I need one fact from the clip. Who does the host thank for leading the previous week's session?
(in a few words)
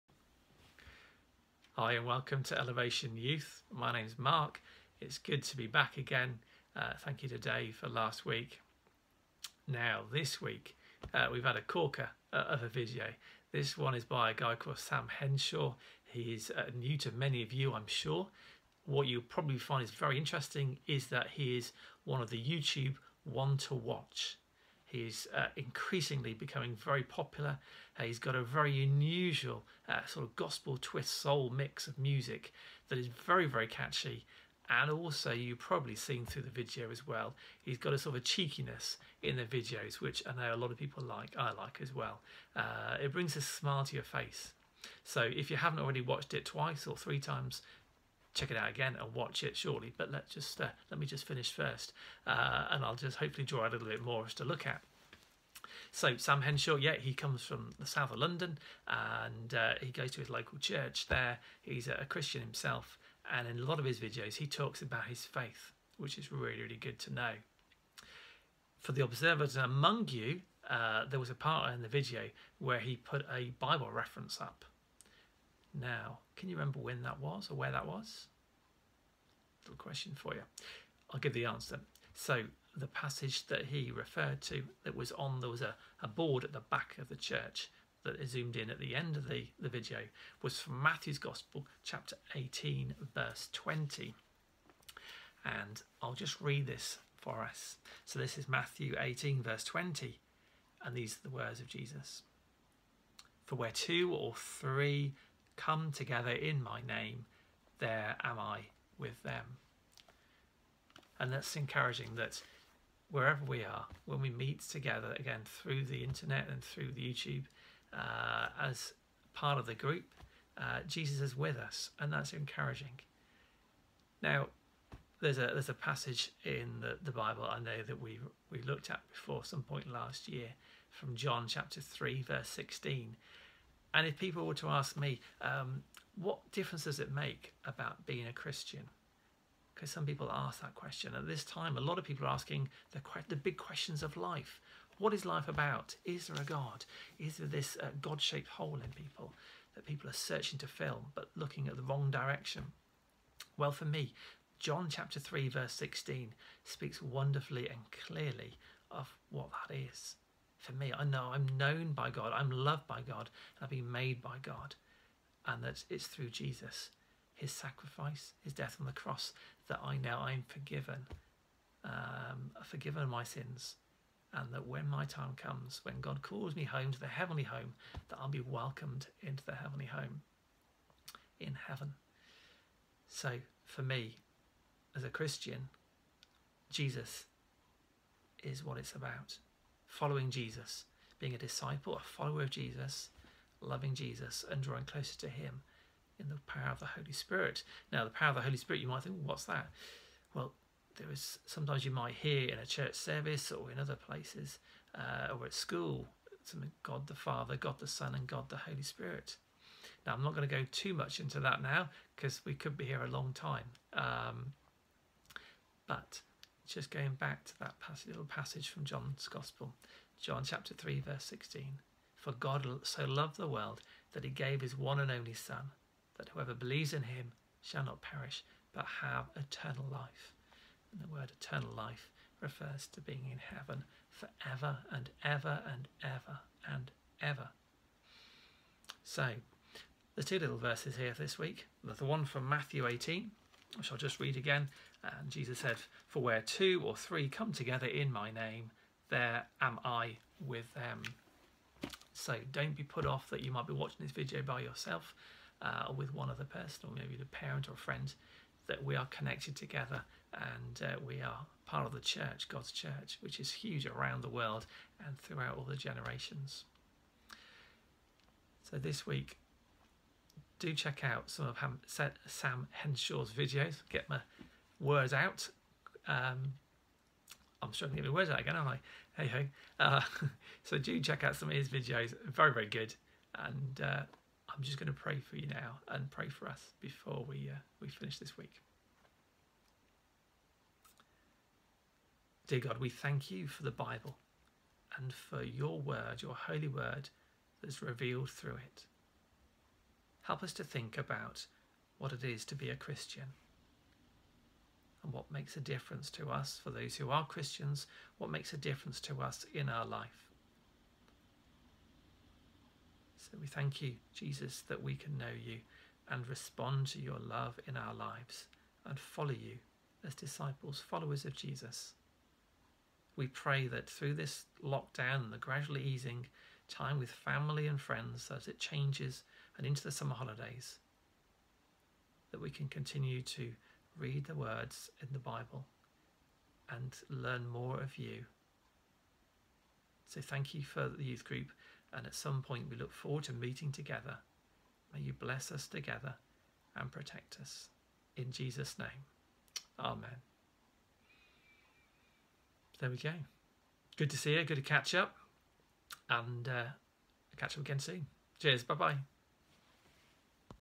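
Dave.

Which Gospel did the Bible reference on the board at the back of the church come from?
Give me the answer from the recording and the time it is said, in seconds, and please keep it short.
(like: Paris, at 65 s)
Matthew's Gospel, at 90 s.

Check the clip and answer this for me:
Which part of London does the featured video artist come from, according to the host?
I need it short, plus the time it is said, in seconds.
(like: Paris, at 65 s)
South of London, at 57 s.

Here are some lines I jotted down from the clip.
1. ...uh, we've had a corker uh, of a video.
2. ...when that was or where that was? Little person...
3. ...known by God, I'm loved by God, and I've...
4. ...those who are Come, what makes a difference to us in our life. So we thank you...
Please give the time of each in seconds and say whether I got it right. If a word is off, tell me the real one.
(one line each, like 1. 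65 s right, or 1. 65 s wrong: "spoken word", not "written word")
1. 11 s right
2. 76 s wrong: "question", not "person"
3. 161 s right
4. 306 s wrong: "Christians", not "Come".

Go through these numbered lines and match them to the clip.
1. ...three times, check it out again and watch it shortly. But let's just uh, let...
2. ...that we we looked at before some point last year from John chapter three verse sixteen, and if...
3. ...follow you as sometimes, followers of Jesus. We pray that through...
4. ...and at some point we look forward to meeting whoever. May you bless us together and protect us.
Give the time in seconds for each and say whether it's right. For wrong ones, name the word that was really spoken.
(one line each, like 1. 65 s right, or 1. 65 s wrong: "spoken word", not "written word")
1. 46 s right
2. 127 s right
3. 318 s wrong: "disciples", not "sometimes"
4. 341 s wrong: "together", not "whoever".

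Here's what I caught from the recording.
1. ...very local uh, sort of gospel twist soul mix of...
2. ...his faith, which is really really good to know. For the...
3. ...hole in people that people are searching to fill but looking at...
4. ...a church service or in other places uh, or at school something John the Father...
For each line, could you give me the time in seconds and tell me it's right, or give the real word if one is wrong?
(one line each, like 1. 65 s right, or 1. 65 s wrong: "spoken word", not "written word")
1. 28 s wrong: "unusual", not "local"
2. 65 s right
3. 148 s right
4. 202 s wrong: "God", not "John".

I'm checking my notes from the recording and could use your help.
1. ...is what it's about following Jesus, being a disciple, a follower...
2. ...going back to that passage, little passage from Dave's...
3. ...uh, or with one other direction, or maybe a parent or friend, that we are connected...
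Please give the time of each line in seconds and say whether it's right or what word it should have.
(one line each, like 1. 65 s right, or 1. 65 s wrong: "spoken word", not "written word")
1. 188 s right
2. 216 s wrong: "John", not "Dave"
3. 255 s wrong: "person", not "direction".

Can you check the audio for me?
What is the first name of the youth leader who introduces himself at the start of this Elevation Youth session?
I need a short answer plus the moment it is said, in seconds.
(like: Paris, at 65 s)
Mark, at 4 s.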